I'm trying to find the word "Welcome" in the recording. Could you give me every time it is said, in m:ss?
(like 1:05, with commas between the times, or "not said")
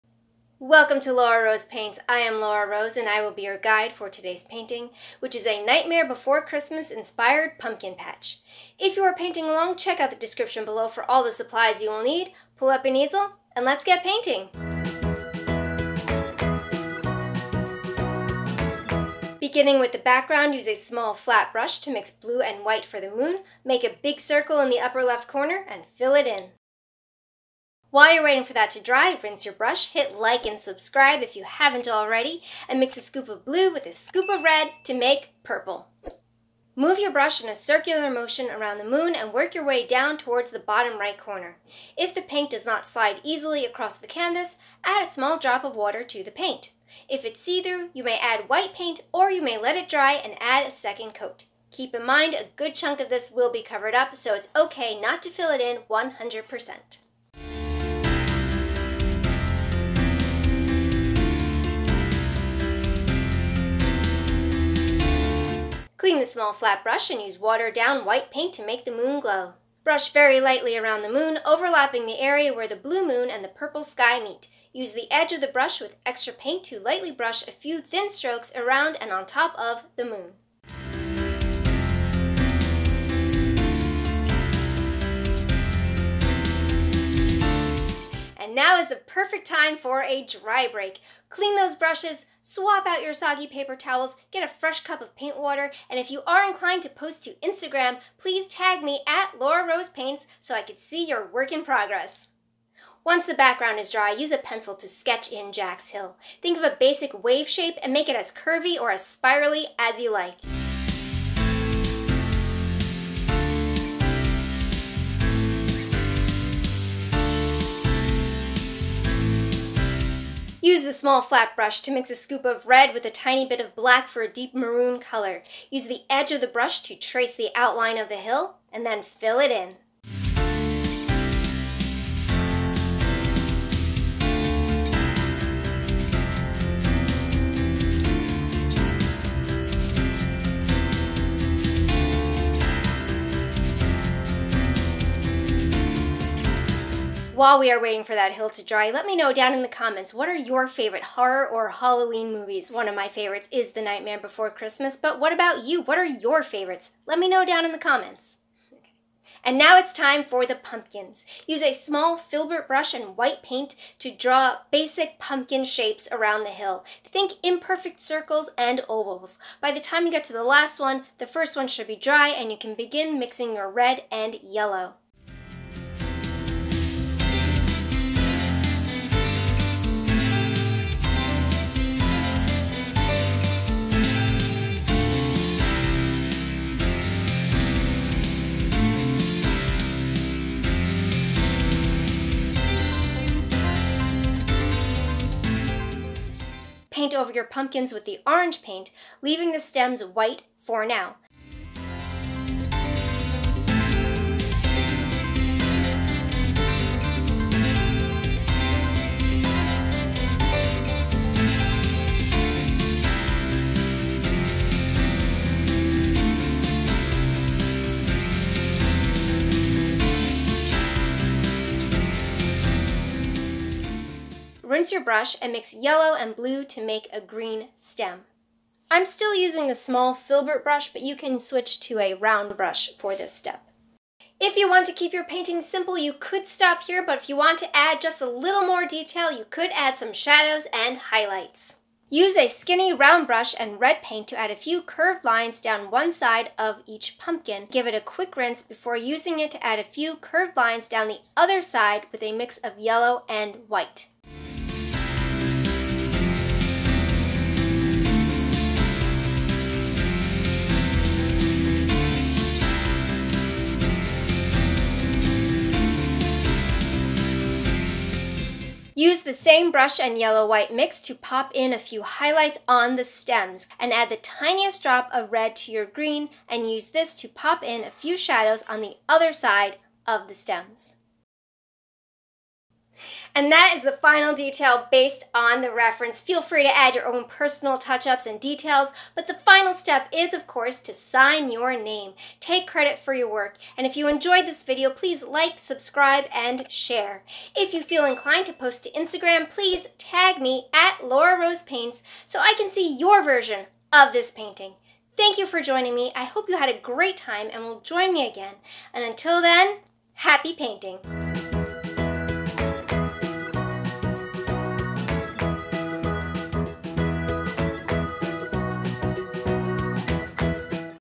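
0:00.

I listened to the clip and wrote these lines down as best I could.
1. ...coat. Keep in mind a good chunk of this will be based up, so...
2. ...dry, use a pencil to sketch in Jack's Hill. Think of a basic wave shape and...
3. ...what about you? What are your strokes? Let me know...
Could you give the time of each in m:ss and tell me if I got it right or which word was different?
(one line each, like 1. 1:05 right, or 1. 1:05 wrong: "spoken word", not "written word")
1. 0:51 wrong: "covered", not "based"
2. 1:43 right
3. 2:35 wrong: "favorites", not "strokes".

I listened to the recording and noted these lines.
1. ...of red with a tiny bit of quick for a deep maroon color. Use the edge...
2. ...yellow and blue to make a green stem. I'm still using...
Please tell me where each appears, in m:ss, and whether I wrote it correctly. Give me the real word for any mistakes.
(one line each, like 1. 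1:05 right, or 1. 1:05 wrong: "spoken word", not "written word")
1. 2:02 wrong: "black", not "quick"
2. 3:45 right.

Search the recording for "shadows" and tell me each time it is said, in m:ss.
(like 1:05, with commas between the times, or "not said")
4:00, 4:38.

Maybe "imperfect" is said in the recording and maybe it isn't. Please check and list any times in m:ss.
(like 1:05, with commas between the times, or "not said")
2:47.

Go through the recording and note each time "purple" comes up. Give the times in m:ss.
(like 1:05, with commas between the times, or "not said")
0:35, 1:13.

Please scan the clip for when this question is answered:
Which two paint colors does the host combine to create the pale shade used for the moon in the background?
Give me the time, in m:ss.
0:22.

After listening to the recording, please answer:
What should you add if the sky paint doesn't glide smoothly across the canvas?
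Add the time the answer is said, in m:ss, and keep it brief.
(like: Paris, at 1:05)
A small drop of water, at 0:45.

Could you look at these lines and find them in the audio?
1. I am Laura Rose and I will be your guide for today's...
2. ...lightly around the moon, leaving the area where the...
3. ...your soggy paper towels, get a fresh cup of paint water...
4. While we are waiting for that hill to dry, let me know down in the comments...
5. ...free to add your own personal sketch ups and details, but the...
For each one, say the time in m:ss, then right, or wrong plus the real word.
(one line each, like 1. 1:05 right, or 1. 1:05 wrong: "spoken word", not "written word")
1. 0:02 right
2. 1:10 wrong: "overlapping", not "leaving"
3. 1:33 right
4. 2:27 right
5. 4:46 wrong: "touch", not "sketch".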